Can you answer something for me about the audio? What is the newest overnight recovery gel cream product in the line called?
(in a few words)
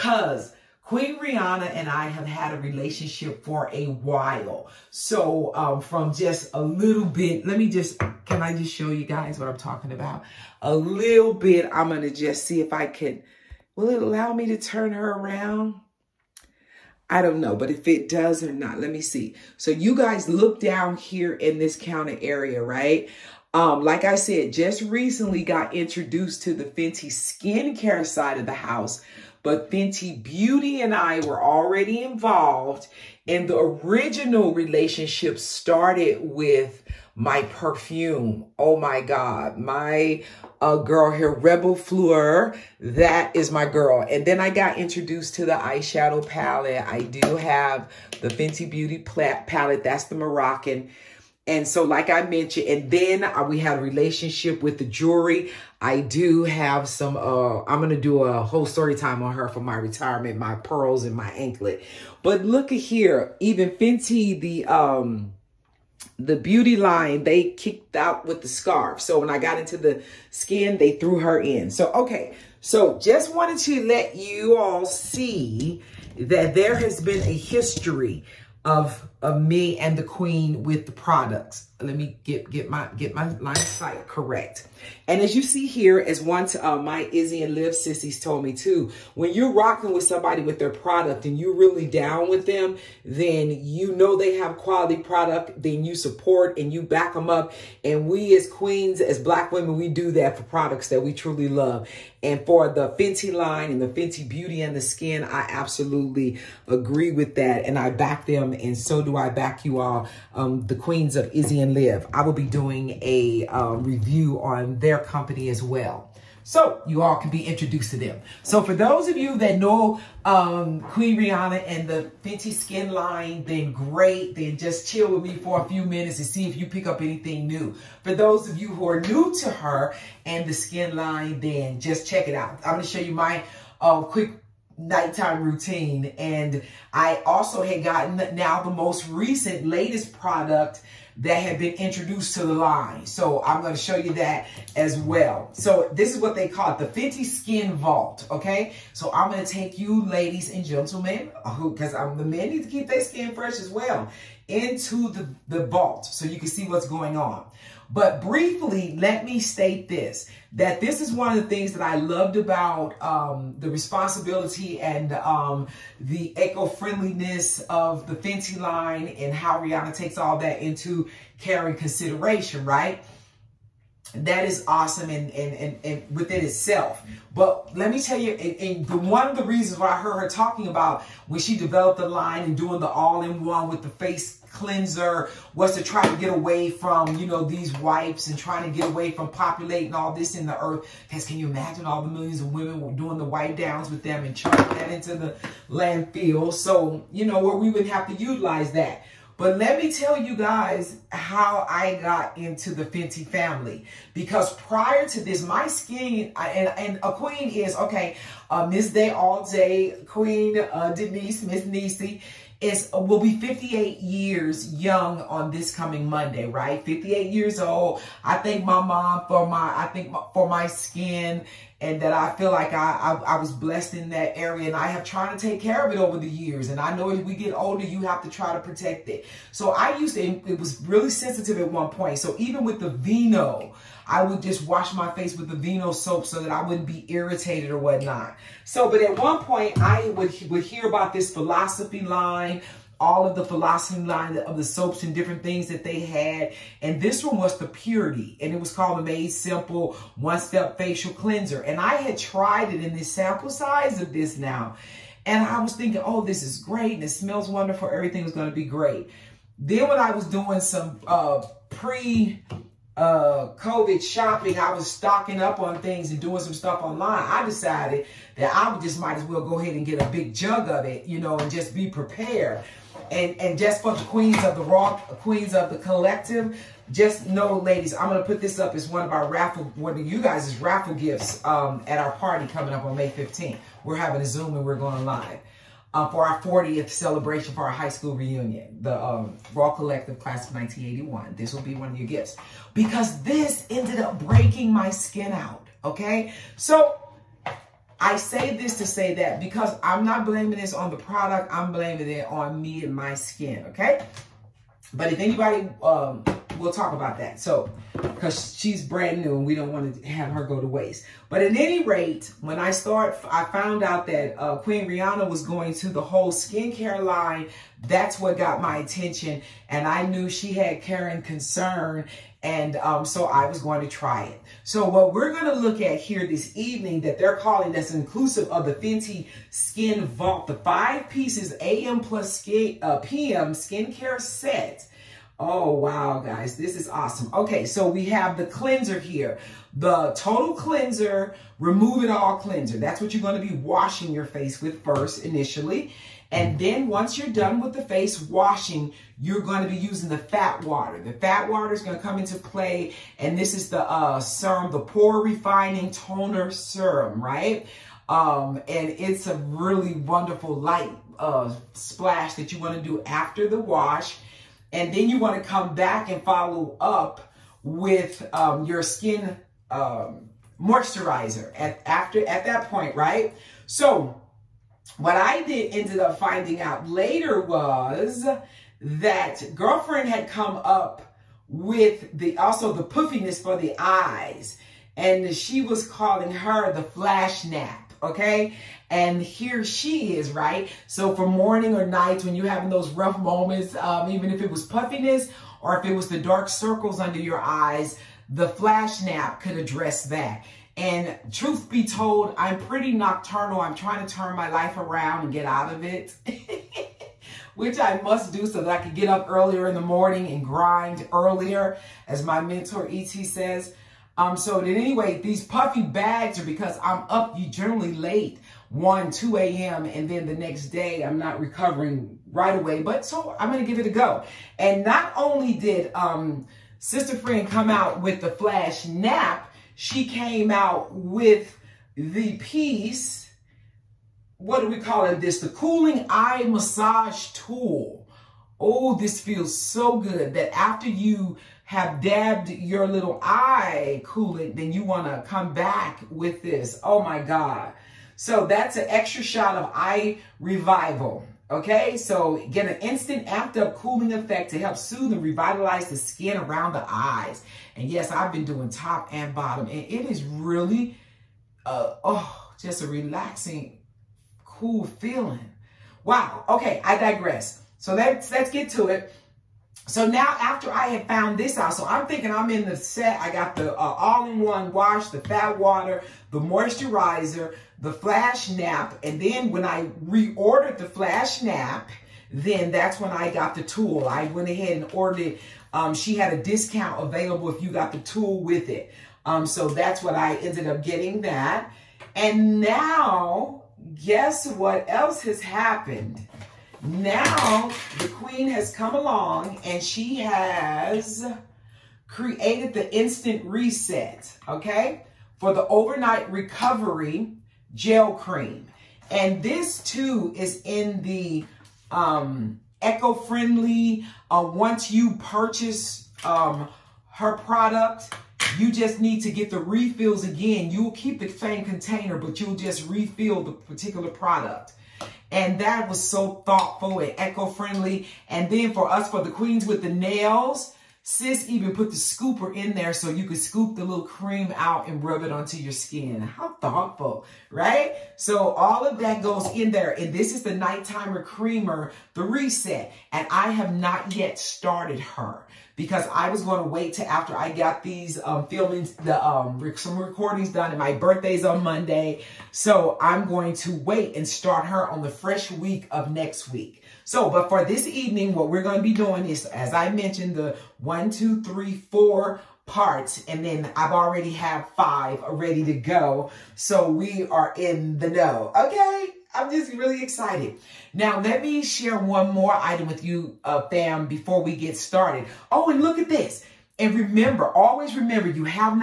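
Instant Reset.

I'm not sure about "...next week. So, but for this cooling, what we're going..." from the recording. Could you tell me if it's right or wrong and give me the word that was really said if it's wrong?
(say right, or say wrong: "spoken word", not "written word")
wrong: "evening", not "cooling".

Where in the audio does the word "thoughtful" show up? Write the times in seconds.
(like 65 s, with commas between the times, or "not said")
526 s, 536 s.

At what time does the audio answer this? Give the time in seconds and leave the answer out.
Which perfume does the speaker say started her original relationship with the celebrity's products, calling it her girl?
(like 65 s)
41 s.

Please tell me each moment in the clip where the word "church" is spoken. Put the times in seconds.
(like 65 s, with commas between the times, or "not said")
not said.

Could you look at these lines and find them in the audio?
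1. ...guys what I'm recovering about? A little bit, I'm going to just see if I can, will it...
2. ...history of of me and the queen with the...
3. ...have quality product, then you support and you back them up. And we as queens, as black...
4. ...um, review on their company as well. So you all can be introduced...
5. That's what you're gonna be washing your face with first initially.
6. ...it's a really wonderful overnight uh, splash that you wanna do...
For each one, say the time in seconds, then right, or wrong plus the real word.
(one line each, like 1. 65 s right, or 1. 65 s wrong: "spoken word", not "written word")
1. 9 s wrong: "talking", not "recovering"
2. 77 s right
3. 94 s right
4. 113 s right
5. 342 s right
6. 358 s wrong: "light", not "overnight".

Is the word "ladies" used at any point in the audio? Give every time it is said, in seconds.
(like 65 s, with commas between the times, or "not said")
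150 s, 277 s.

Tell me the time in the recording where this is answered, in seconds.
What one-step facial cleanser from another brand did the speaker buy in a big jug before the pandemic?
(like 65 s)
247 s.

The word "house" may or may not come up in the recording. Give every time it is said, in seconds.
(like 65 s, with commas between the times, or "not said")
28 s.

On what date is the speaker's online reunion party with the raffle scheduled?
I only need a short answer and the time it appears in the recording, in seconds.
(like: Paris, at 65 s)
May 15th, at 282 s.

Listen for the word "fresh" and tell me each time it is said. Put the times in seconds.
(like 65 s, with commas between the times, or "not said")
153 s, 555 s.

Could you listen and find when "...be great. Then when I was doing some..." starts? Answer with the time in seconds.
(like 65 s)
258 s.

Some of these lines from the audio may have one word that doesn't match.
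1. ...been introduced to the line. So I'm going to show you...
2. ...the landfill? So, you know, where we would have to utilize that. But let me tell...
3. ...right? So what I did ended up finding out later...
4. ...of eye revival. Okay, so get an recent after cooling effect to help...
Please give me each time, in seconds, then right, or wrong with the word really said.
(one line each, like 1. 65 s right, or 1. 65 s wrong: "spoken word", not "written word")
1. 141 s right
2. 195 s right
3. 372 s right
4. 449 s wrong: "instant", not "recent".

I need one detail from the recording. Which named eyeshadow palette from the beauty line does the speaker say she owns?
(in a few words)
The Moroccan.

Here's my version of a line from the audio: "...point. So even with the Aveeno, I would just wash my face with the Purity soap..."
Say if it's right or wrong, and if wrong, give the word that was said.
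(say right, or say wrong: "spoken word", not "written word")
wrong: "Aveeno", not "Purity".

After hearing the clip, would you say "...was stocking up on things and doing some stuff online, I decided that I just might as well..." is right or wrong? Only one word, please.
right.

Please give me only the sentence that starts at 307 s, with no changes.
So, because she's brand new and we don't want to have her go to waste.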